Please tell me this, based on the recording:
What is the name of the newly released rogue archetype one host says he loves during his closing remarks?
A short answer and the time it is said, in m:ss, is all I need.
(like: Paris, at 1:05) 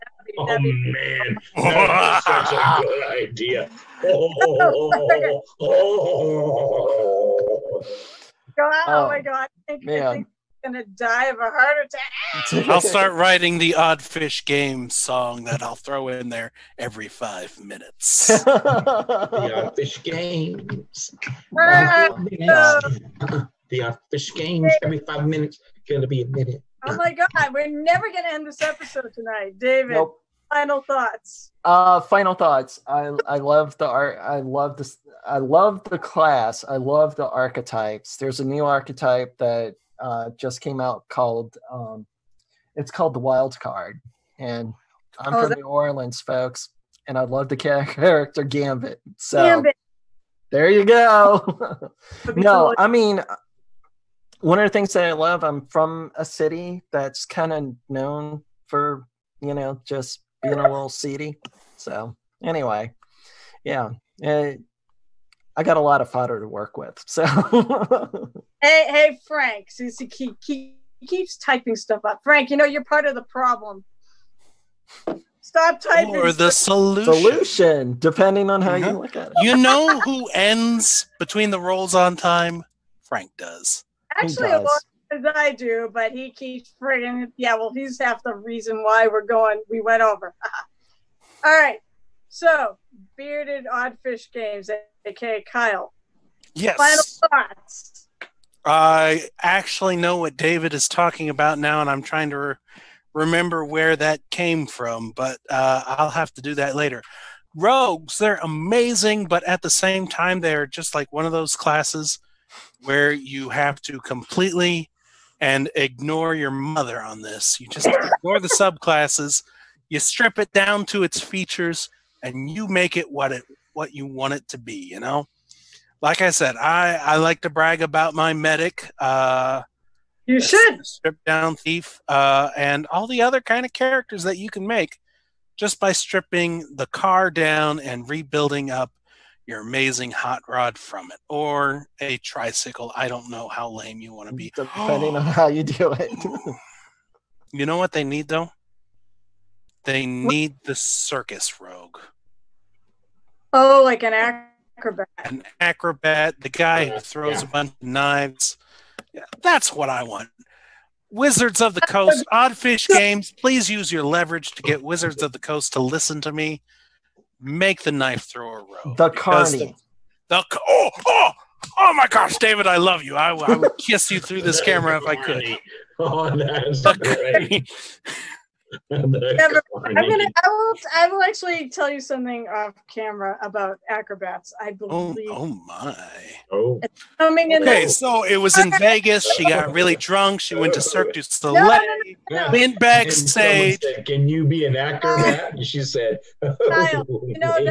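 The Wild Card, at 0:43.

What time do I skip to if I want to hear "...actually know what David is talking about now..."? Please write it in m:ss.
1:39.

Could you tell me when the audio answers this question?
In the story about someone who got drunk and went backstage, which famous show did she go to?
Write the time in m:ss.
3:10.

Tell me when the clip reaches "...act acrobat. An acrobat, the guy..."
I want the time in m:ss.
2:34.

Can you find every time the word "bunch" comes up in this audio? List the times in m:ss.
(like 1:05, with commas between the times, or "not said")
2:37.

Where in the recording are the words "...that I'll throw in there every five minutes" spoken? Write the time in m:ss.
0:15.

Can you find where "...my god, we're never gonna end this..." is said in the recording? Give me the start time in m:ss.
0:26.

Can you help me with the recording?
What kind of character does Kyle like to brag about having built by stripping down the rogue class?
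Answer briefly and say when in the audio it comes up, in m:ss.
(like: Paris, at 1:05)
medic, at 2:08.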